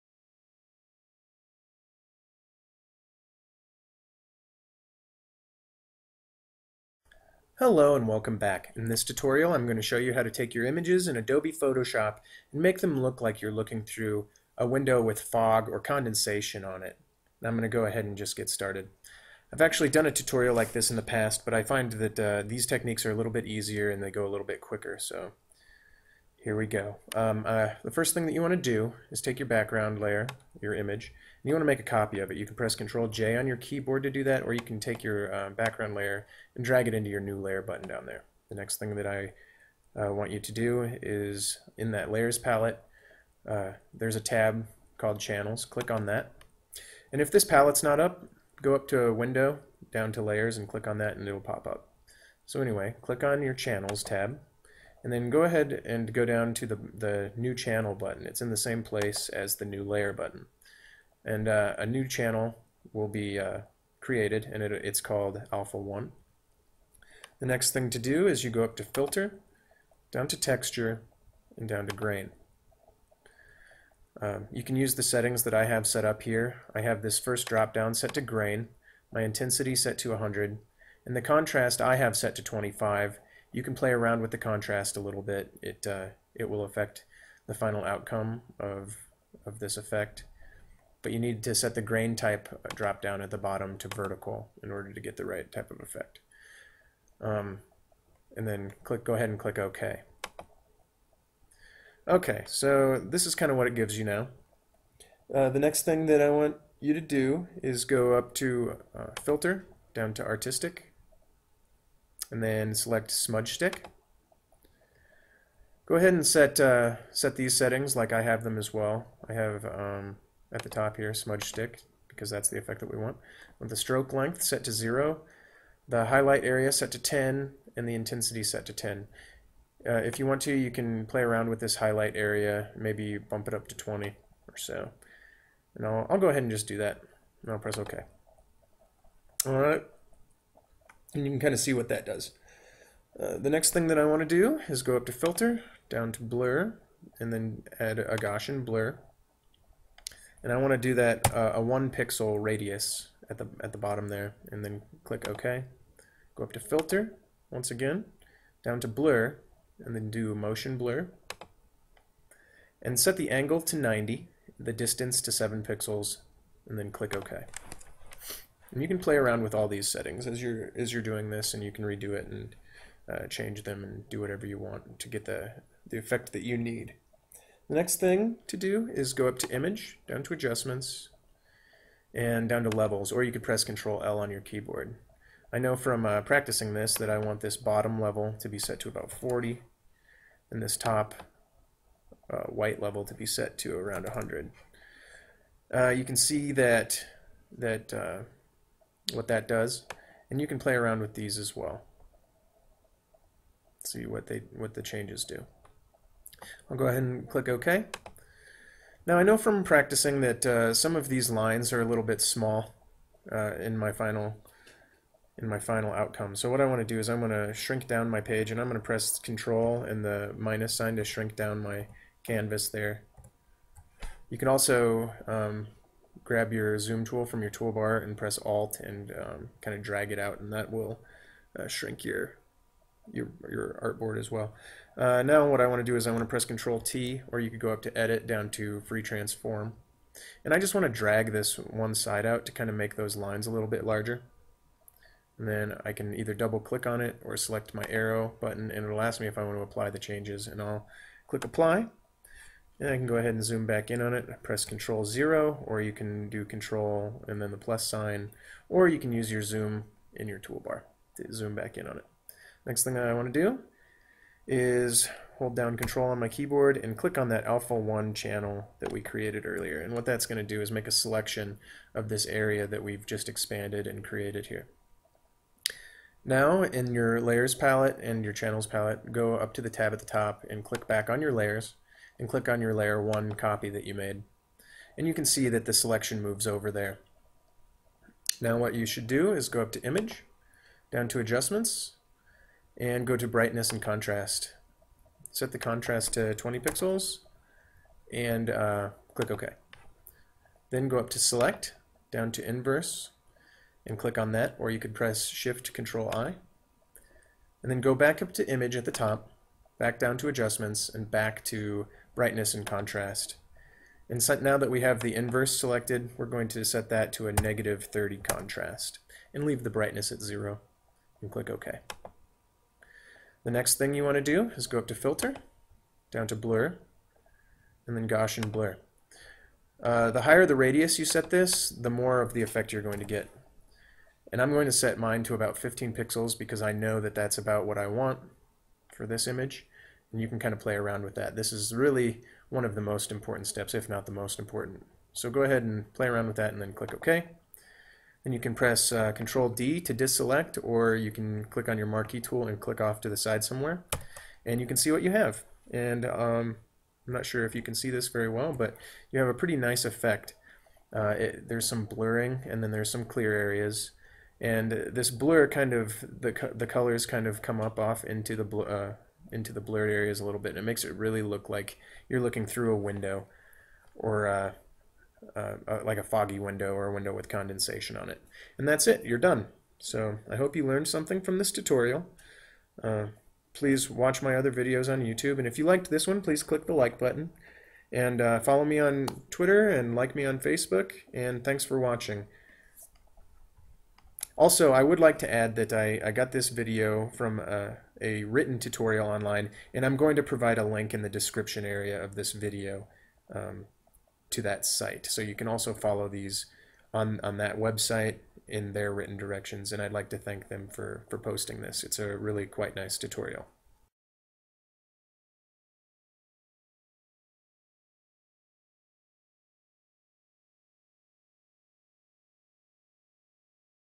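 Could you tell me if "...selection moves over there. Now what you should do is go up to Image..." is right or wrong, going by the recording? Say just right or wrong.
right.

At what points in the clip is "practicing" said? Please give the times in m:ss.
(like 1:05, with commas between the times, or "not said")
3:06, 3:29.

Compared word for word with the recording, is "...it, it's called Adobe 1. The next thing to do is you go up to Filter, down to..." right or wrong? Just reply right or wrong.
wrong.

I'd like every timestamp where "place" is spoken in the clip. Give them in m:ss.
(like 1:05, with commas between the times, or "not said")
0:58.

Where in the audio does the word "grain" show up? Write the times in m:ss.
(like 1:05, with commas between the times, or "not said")
1:11, 1:18, 1:31.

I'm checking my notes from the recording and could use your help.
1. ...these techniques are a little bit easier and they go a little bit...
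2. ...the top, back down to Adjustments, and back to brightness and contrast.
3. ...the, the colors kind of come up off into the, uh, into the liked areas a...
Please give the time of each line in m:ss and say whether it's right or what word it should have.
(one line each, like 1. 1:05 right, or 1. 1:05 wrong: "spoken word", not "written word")
1. 0:22 right
2. 5:08 right
3. 6:06 wrong: "blurred", not "liked".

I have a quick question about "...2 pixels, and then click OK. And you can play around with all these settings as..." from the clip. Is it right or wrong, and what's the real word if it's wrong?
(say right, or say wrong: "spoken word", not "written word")
wrong: "7", not "2".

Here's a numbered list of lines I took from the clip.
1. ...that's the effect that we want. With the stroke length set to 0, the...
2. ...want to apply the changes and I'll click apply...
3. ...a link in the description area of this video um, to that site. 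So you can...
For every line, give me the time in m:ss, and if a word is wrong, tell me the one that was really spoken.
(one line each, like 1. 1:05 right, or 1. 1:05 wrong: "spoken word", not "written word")
1. 2:02 right
2. 4:09 right
3. 6:40 right.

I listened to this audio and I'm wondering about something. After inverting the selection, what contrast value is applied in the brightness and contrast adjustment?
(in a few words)
-30.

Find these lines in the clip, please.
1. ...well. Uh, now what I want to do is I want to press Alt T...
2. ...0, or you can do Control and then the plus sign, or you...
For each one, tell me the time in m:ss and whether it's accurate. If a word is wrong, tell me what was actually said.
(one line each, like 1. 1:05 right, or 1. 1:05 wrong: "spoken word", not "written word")
1. 3:54 wrong: "Control", not "Alt"
2. 4:15 right.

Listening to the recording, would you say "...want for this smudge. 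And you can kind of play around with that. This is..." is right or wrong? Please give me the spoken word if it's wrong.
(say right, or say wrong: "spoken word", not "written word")
wrong: "image", not "smudge".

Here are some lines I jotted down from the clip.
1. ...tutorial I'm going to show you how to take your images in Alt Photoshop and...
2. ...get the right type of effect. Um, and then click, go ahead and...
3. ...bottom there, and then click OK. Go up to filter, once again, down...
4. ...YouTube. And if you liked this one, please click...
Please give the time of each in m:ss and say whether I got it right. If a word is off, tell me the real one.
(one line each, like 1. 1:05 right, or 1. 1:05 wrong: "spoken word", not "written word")
1. 0:09 wrong: "Adobe", not "Alt"
2. 1:35 right
3. 2:33 right
4. 6:25 right.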